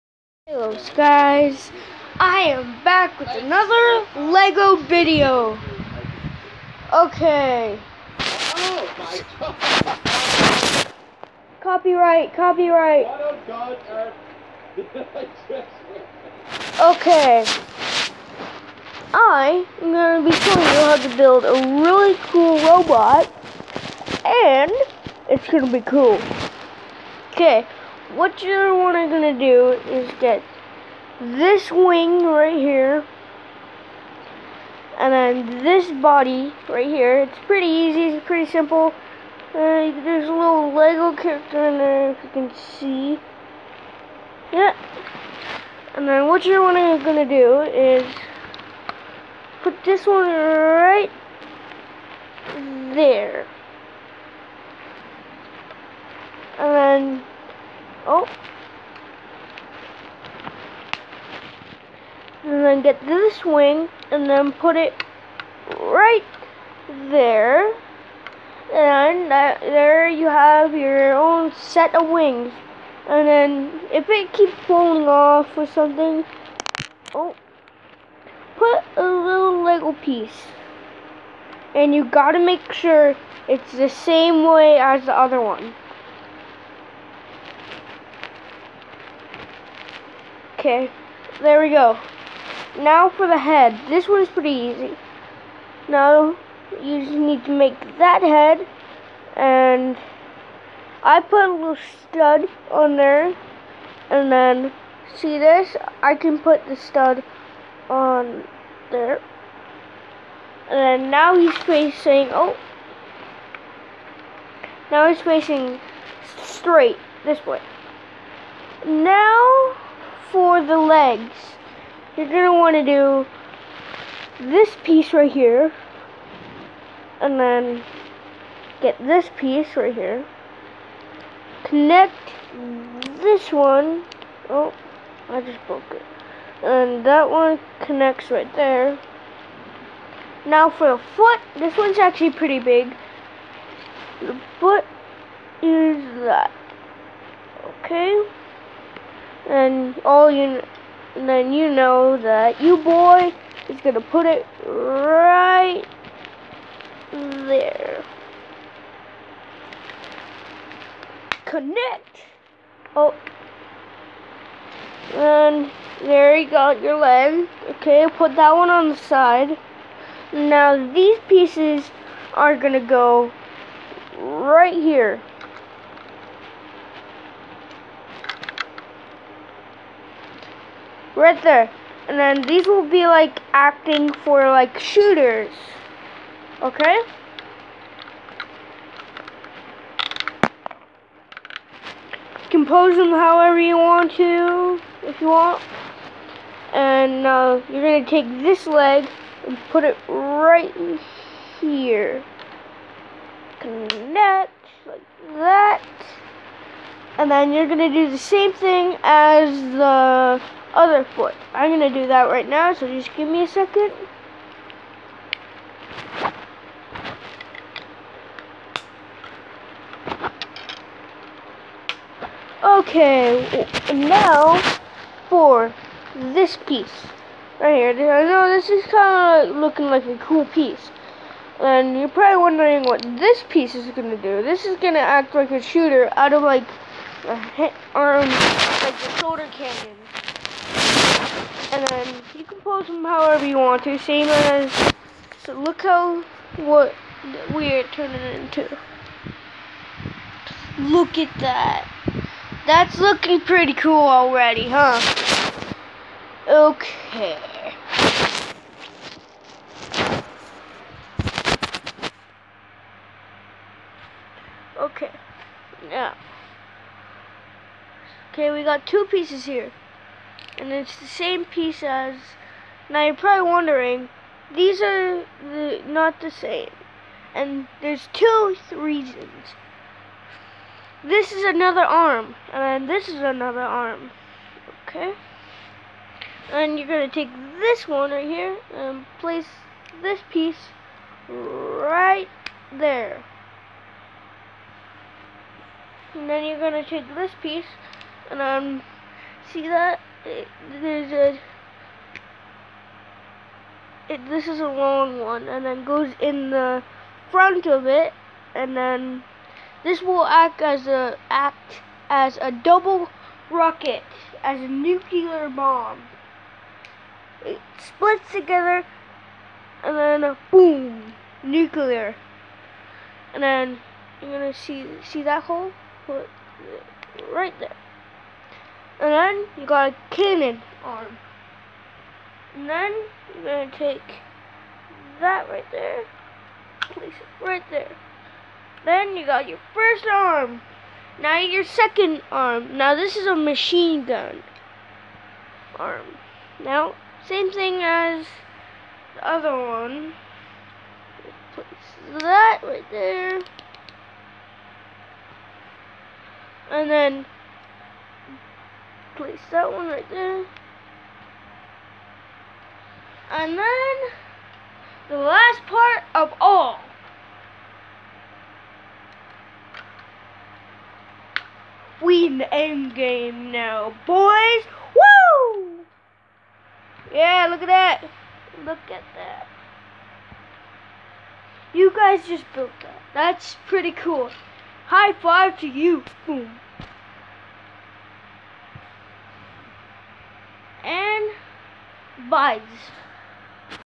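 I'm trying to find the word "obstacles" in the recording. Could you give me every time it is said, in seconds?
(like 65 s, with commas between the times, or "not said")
not said.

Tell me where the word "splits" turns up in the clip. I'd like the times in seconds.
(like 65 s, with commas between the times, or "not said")
317 s.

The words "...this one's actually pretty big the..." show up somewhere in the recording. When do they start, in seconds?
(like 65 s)
141 s.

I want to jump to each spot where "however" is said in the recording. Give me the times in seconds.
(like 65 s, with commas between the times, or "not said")
193 s, 243 s.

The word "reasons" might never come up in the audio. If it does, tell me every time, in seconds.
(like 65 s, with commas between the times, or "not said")
278 s.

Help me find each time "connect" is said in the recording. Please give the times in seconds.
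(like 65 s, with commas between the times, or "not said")
131 s, 137 s, 161 s, 203 s.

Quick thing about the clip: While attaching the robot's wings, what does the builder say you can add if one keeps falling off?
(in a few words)
a little Lego piece.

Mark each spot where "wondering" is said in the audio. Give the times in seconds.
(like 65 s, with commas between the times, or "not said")
232 s, 273 s.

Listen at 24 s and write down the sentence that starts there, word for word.
And it's going to be cool.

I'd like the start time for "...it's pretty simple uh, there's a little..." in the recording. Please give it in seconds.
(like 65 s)
38 s.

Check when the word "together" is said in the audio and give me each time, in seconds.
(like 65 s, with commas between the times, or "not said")
318 s.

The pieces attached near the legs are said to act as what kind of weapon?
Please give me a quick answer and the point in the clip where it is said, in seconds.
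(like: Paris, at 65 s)
shooters, at 184 s.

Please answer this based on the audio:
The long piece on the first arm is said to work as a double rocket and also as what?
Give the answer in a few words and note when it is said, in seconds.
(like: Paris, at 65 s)
nuclear bomb, at 314 s.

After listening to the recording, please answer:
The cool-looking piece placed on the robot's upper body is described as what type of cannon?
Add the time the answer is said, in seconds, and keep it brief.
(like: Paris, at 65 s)
shoulder cannon, at 239 s.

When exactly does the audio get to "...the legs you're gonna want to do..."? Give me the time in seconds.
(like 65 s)
120 s.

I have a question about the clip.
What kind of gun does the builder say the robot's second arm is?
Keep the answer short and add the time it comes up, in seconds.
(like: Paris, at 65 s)
machine gun, at 343 s.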